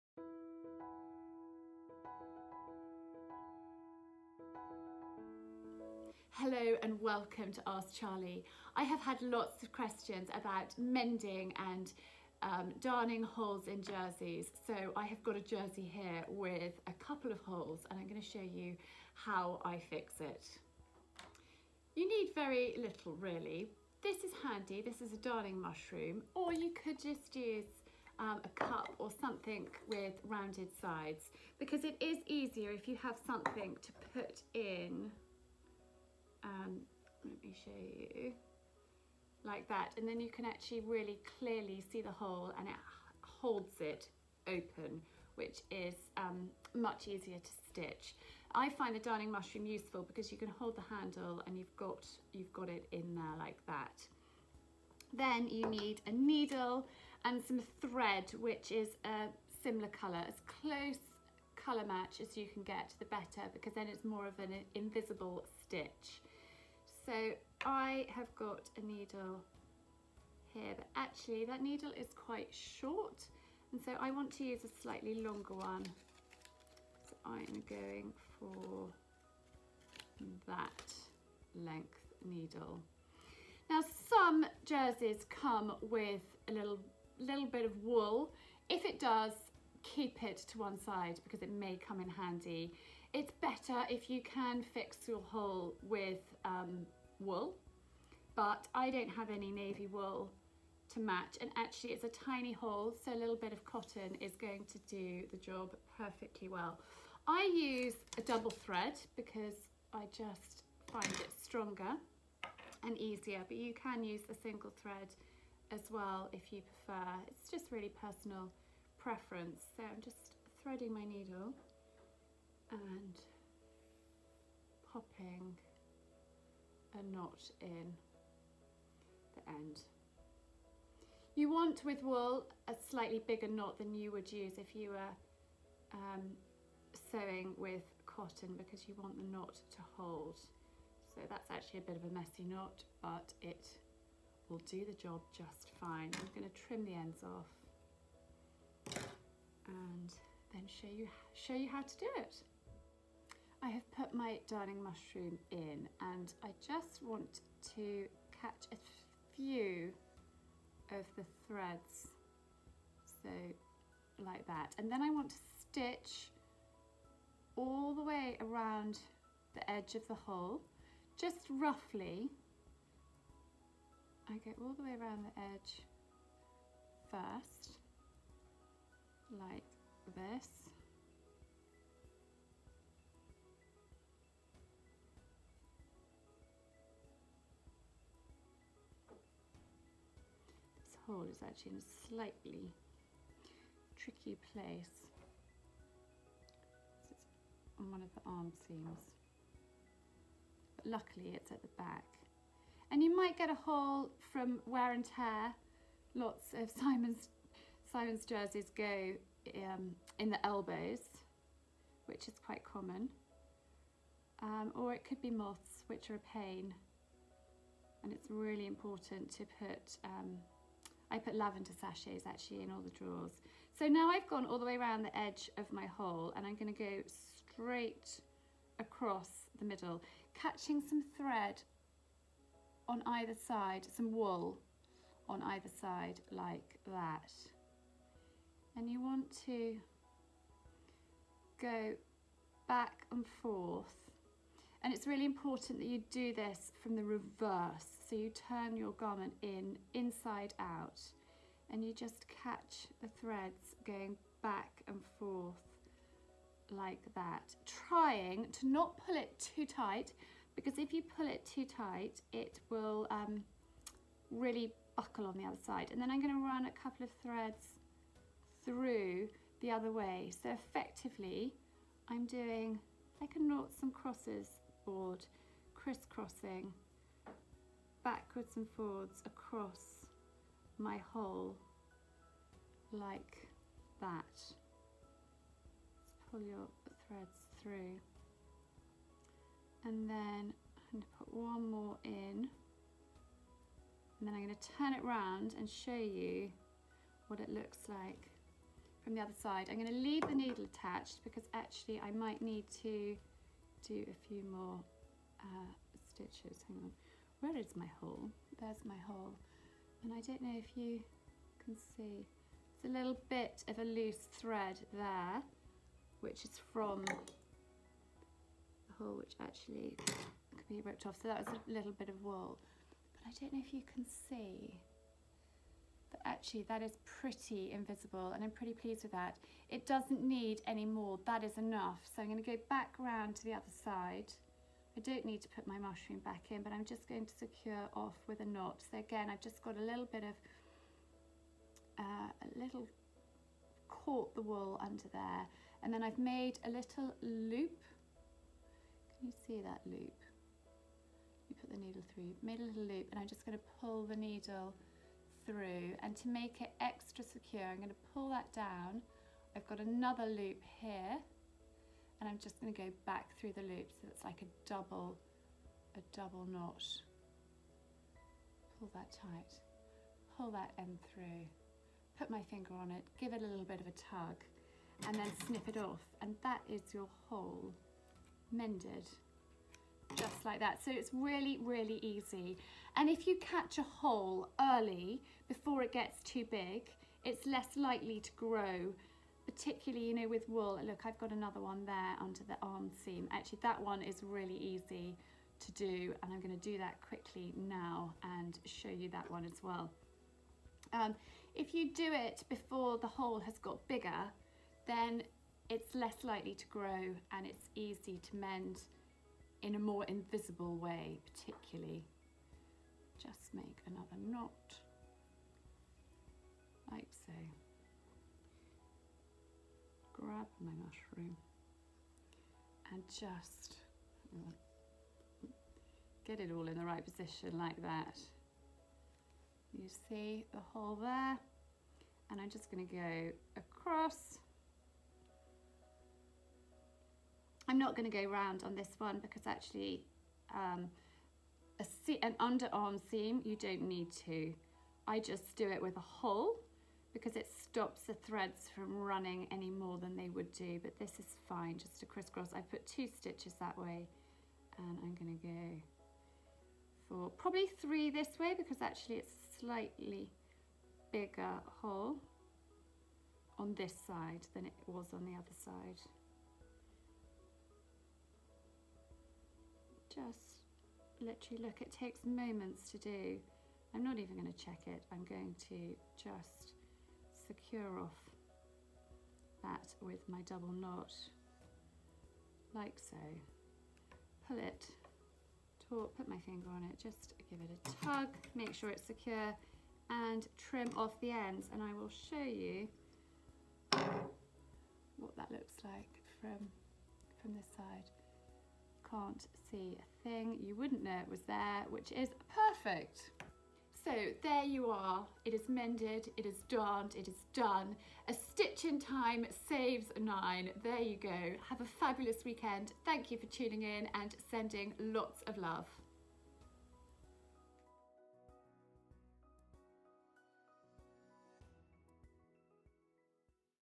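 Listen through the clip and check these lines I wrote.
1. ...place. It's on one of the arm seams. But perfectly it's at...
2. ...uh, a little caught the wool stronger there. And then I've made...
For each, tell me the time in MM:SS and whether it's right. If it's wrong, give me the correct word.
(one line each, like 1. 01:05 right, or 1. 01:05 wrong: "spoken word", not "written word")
1. 03:14 wrong: "luckily", not "perfectly"
2. 05:42 wrong: "under", not "stronger".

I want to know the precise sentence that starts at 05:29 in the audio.
It doesn't need any more, that is enough.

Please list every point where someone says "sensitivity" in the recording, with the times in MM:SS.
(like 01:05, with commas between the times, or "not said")
not said.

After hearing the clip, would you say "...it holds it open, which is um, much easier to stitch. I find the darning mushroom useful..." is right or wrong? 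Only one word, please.
right.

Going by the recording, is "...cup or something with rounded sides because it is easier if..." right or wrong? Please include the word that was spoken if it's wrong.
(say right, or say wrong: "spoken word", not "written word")
right.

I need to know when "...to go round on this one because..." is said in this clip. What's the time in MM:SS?
07:18.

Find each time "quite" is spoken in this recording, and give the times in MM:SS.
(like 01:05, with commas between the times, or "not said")
01:12, 03:32.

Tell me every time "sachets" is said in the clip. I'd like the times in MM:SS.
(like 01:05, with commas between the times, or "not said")
03:41.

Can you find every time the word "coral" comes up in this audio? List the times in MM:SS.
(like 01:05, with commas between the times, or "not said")
03:11.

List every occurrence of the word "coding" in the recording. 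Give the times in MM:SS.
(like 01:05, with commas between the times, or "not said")
not said.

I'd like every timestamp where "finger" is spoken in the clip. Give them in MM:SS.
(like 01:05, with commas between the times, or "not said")
06:12, 08:06.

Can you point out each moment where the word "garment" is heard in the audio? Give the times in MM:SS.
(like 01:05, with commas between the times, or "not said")
04:08.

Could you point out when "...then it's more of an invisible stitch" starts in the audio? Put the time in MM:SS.
01:03.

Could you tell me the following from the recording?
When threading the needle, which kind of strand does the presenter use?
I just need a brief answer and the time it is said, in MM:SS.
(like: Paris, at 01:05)
double thread, at 01:48.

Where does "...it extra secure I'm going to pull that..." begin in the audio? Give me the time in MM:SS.
05:56.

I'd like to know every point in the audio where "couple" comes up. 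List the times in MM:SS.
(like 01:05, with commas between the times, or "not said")
00:16, 04:26.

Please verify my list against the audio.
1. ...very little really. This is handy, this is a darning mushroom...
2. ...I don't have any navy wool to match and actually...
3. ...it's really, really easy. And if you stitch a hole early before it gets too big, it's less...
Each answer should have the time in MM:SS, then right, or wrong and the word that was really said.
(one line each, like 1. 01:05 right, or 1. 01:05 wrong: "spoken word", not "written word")
1. 00:22 right
2. 01:38 right
3. 06:20 wrong: "catch", not "stitch".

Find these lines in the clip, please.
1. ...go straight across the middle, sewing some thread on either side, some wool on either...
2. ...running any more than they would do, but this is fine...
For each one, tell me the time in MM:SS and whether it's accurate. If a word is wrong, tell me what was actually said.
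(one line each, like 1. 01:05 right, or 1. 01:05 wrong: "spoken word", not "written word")
1. 03:46 wrong: "catching", not "sewing"
2. 07:28 right.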